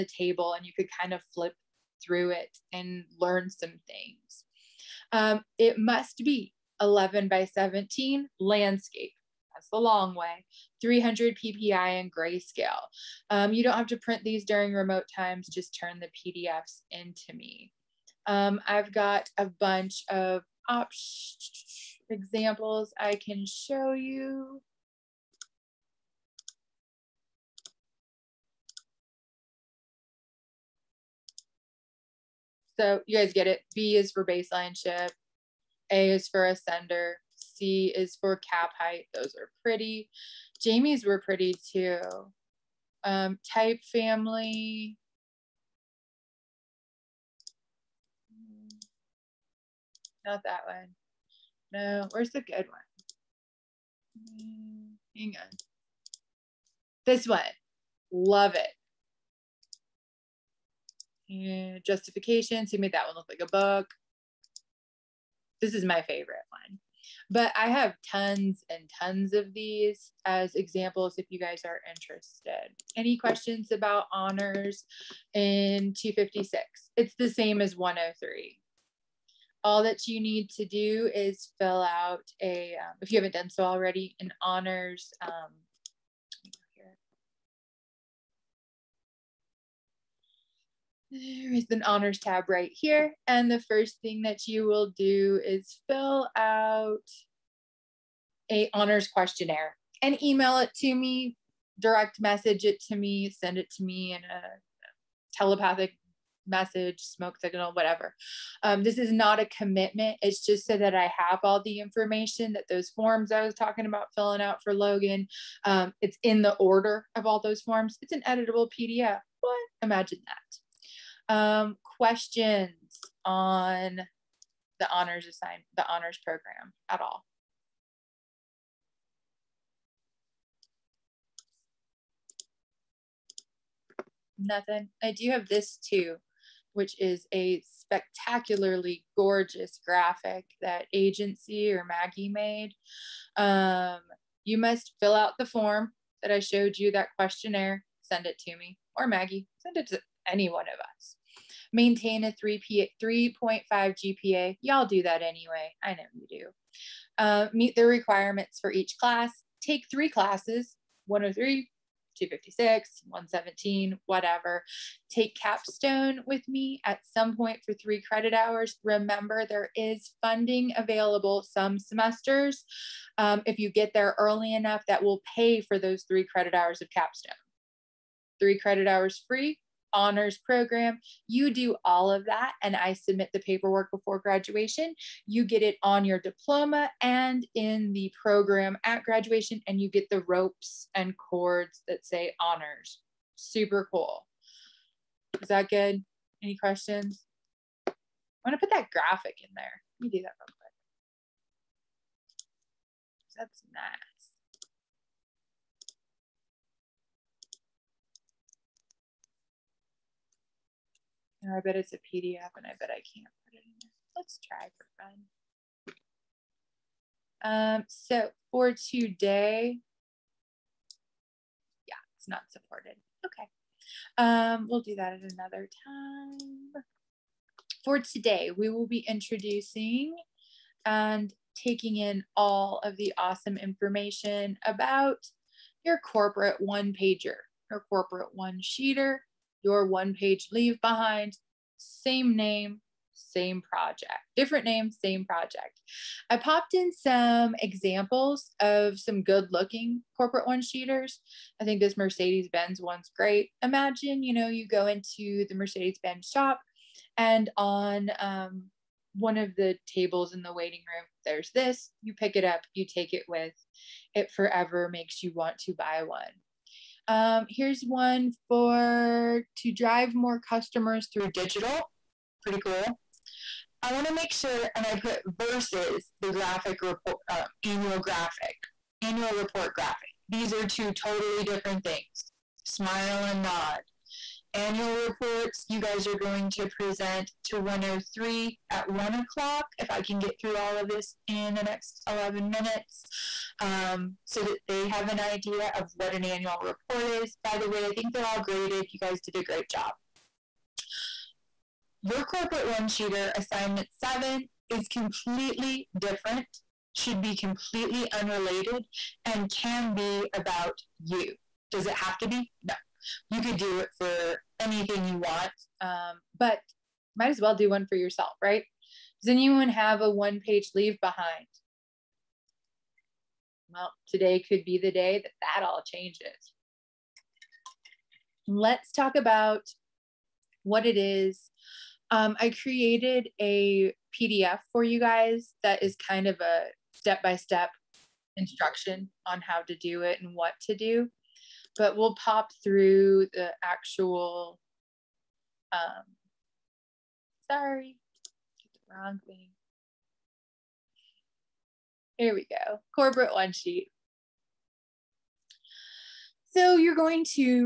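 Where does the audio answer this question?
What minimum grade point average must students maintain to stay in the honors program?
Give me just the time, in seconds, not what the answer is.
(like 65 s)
153 s.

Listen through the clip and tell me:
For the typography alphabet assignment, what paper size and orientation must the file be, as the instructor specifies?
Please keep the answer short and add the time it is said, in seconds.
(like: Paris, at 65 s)
11 by 17 landscape, at 6 s.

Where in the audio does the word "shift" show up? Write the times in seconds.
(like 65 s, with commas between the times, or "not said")
34 s.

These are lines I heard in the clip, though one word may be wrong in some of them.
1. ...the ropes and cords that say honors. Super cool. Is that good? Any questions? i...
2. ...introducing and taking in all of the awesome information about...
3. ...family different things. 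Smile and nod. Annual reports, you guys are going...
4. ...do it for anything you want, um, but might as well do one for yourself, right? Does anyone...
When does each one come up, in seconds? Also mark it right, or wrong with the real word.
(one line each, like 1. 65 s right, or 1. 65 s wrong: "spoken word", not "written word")
1. 190 s right
2. 229 s right
3. 280 s wrong: "totally", not "family"
4. 313 s right.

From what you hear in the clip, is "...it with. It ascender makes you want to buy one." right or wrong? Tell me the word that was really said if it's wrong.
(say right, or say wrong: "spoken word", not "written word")
wrong: "forever", not "ascender".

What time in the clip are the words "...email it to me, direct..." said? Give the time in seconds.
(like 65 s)
100 s.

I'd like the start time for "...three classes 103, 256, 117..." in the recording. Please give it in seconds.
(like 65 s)
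159 s.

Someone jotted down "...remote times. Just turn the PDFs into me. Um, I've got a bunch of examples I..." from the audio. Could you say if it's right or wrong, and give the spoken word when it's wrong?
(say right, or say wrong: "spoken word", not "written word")
right.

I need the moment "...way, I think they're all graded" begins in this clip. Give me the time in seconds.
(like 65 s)
297 s.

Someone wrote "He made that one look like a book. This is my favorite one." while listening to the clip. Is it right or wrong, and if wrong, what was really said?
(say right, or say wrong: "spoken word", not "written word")
right.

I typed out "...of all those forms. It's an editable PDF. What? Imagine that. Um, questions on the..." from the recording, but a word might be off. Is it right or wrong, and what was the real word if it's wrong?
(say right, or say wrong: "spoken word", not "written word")
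right.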